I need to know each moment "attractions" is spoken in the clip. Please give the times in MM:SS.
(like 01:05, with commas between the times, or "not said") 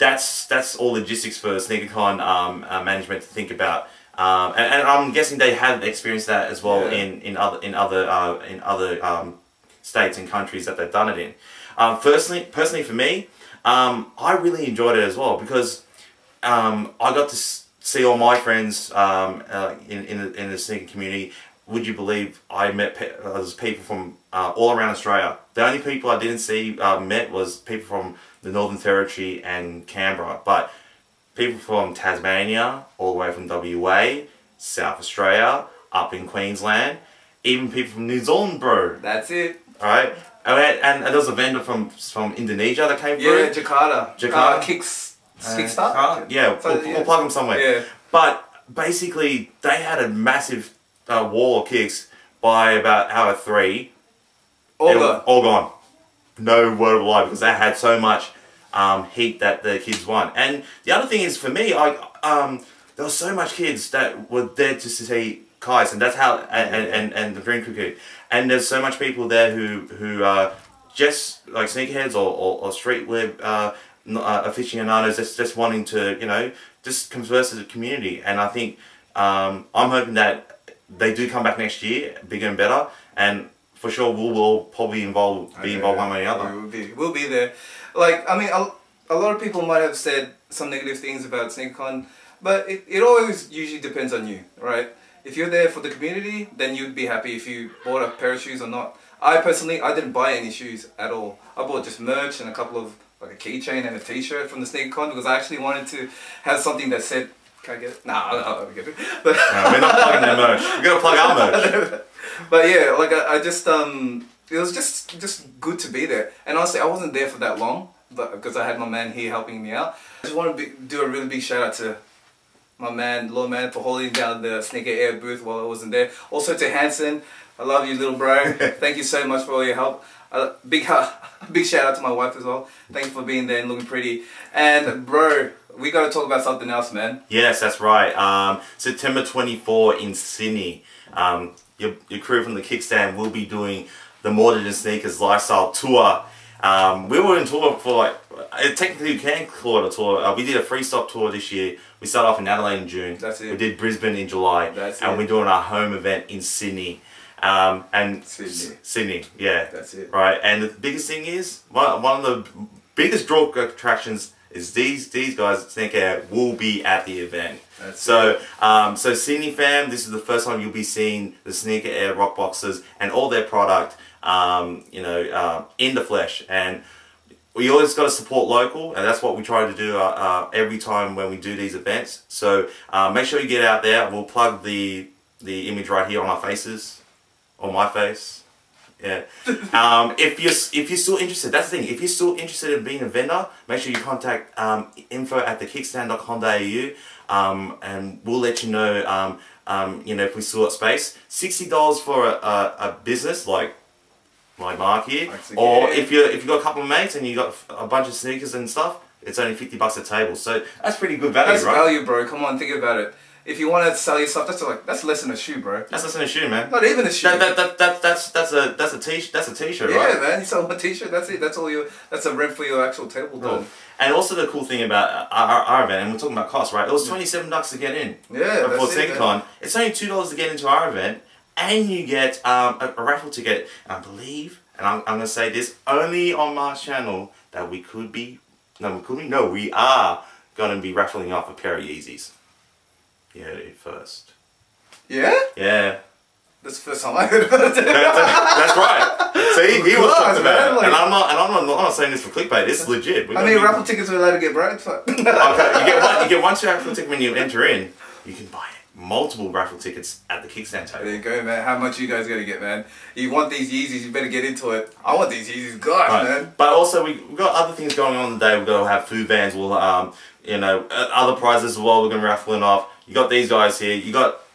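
02:43.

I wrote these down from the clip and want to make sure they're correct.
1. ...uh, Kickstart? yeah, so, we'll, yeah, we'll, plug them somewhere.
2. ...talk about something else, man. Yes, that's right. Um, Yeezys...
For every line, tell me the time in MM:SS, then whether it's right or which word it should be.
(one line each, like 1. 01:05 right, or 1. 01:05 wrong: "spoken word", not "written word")
1. 00:45 right
2. 02:16 wrong: "September", not "Yeezys".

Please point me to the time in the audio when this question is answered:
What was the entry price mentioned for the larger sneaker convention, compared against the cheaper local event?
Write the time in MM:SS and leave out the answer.
03:47.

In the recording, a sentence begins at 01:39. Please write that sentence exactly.
I personally, I didn't buy any shoes at all.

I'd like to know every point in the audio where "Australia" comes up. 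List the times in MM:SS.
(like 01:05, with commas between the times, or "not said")
00:24, 00:34.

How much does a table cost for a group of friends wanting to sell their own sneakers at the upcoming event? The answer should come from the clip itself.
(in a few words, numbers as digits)
$50.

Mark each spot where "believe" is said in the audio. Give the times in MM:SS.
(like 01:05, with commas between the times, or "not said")
00:21, 03:54.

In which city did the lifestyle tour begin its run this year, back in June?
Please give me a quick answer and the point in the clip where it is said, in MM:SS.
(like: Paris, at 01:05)
Adelaide, at 02:32.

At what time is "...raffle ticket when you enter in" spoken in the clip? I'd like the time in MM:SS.
04:16.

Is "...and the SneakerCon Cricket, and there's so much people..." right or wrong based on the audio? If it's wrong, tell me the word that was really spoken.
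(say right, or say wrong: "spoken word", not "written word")
wrong: "Green", not "SneakerCon".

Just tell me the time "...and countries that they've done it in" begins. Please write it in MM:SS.
00:10.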